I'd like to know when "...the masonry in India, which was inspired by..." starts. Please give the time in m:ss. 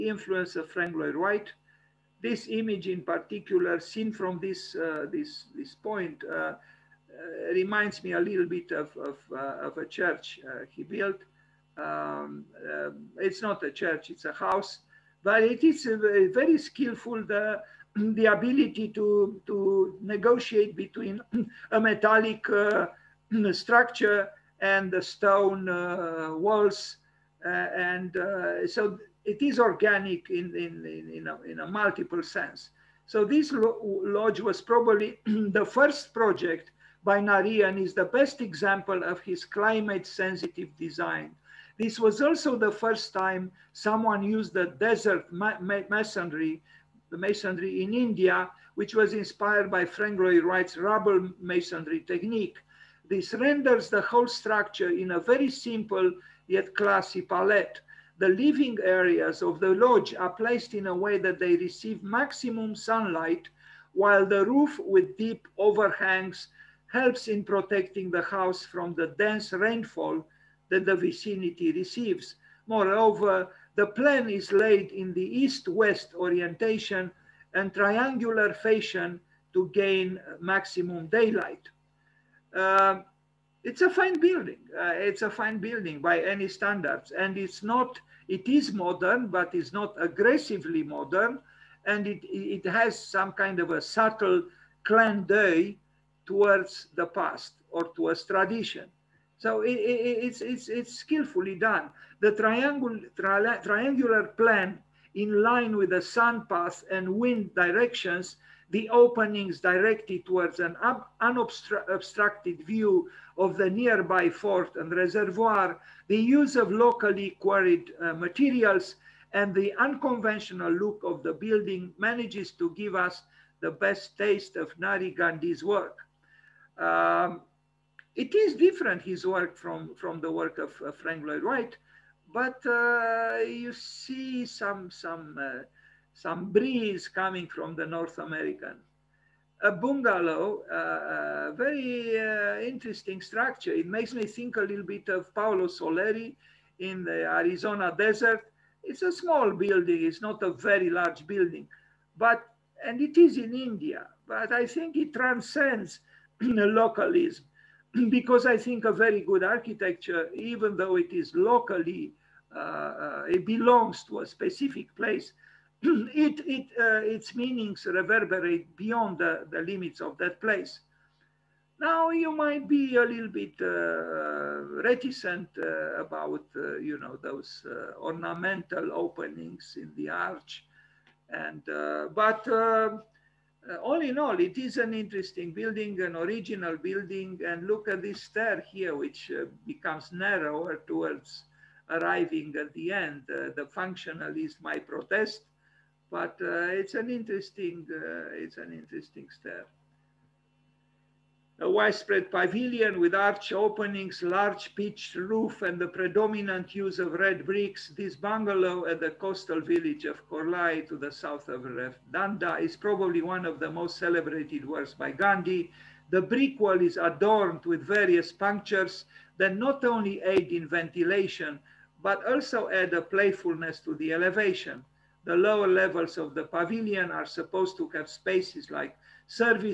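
0:47.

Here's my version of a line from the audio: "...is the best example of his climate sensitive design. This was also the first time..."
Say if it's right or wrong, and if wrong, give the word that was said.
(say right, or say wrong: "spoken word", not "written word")
right.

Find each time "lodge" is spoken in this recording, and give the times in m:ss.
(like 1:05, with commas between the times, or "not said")
0:33, 0:59.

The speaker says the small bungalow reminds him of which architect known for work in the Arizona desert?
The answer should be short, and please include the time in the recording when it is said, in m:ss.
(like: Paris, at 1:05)
Paolo Soleri, at 2:25.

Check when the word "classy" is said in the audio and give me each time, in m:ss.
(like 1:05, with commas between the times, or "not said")
0:56.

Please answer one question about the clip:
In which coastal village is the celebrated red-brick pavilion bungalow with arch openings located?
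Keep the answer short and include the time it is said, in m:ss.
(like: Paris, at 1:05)
Korlai, at 3:30.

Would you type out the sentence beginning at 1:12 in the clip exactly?
Moreover, the plan is laid in the east-west orientation and triangular fashion to gain maximum daylight.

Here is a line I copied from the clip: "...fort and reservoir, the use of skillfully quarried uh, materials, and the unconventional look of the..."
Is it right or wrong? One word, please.
wrong.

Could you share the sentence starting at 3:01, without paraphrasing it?
And, uh, but all in all, it is an interesting building, an original building.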